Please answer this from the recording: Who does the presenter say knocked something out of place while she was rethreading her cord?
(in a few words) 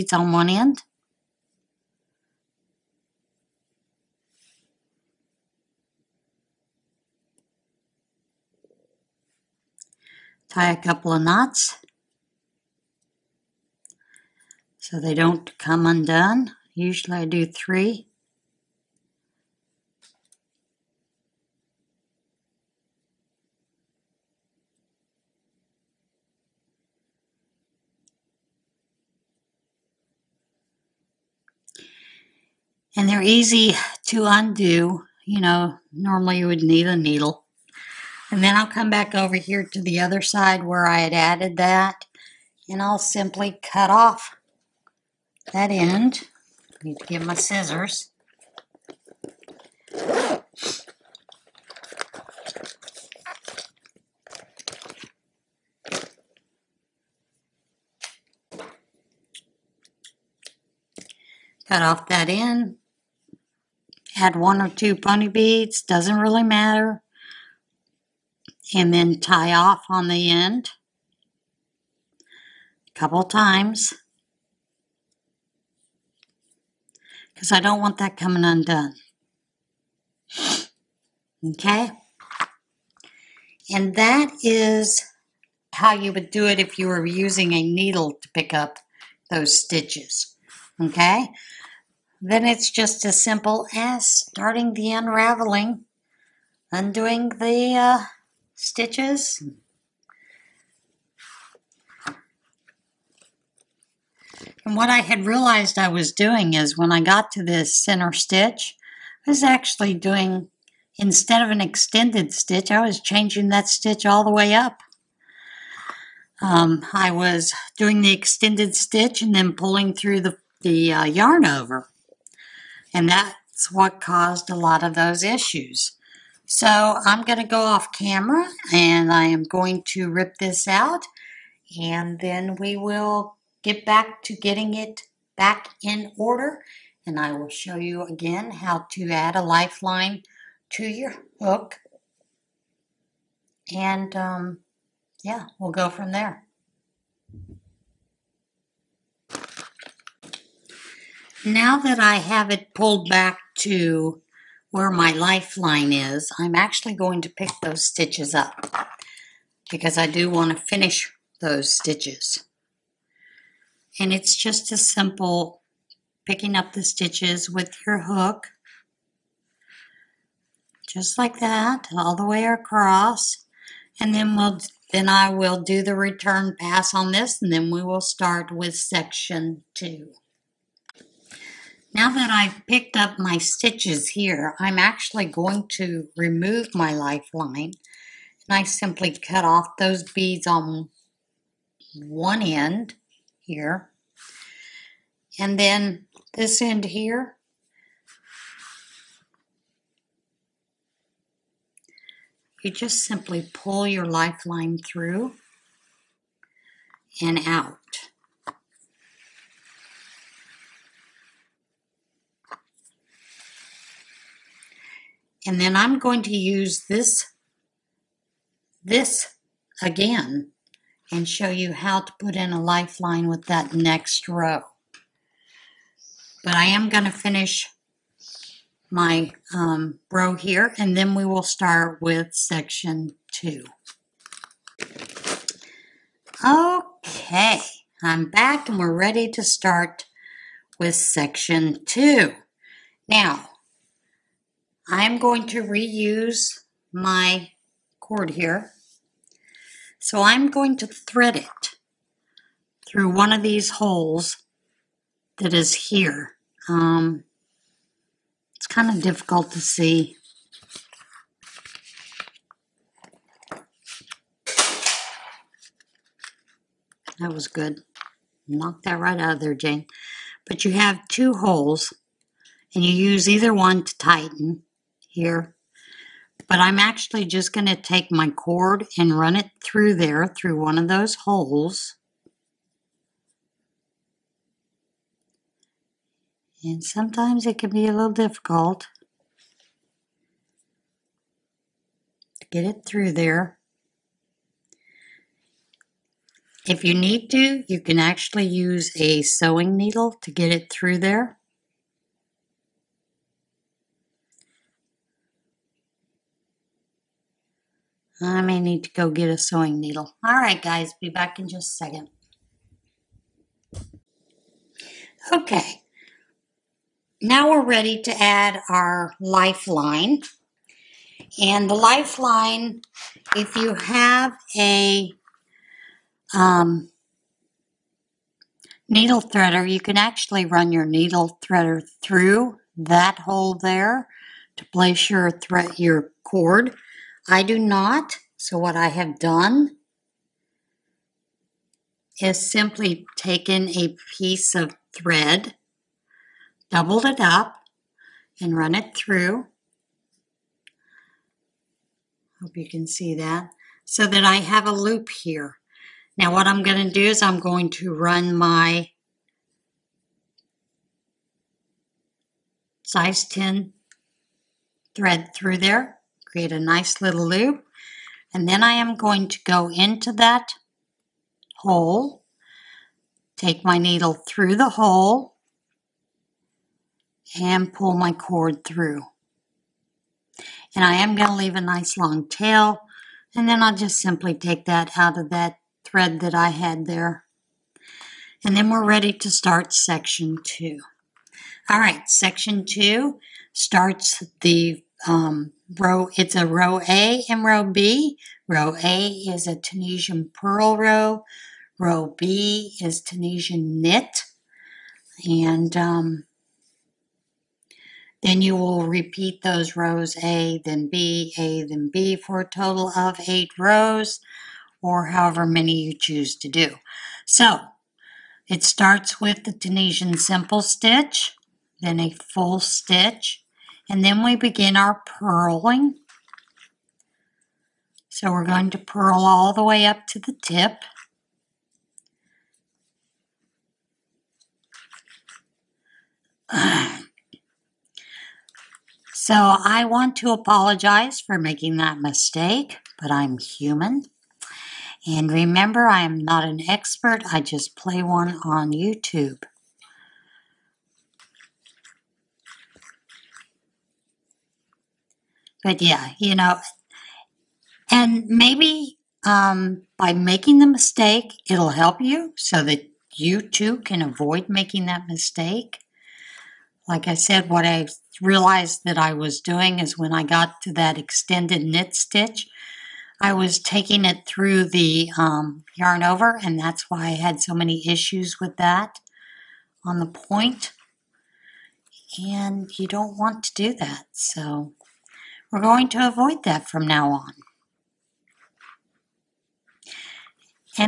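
Jane.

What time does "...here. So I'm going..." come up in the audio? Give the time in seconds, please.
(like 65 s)
248 s.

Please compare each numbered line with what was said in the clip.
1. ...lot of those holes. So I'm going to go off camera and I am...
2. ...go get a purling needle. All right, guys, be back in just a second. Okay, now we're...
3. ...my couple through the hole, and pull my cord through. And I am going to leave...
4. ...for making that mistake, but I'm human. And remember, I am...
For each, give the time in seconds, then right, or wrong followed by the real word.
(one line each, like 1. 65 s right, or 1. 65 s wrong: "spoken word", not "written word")
1. 124 s wrong: "issues", not "holes"
2. 308 s wrong: "sewing", not "purling"
3. 373 s wrong: "needle", not "couple"
4. 441 s right.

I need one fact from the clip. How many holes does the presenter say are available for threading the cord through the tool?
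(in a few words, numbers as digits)
2.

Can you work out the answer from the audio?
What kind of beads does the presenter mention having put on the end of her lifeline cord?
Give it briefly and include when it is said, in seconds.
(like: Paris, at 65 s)
bunny beads, at 64 s.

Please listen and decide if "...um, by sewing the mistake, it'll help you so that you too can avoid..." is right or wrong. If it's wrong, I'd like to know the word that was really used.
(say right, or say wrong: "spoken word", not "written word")
wrong: "making", not "sewing".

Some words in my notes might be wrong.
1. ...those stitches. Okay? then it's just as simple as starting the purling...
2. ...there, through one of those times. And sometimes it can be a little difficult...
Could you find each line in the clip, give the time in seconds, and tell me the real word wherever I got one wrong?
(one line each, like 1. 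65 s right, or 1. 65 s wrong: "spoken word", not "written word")
1. 89 s wrong: "unraveling", not "purling"
2. 279 s wrong: "holes", not "times".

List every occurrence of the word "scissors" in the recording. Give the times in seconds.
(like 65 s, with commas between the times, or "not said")
47 s.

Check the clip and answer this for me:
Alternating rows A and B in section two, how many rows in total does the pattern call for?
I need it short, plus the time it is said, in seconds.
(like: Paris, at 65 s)
8, at 413 s.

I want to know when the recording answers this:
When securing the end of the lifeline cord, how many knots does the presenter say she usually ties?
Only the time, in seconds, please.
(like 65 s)
16 s.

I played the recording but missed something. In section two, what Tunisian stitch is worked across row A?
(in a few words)
Tunisian purl.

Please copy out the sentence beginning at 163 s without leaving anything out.
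And it's just as simple picking up the stitches with your hook, just like that, all the way across.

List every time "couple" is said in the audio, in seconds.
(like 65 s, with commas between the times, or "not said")
10 s, 72 s.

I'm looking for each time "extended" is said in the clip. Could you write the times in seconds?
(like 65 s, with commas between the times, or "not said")
111 s, 118 s, 470 s.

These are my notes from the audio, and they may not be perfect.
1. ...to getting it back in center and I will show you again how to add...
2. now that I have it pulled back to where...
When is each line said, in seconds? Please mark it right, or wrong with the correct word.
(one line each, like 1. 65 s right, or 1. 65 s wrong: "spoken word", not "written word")
1. 134 s wrong: "order", not "center"
2. 151 s right.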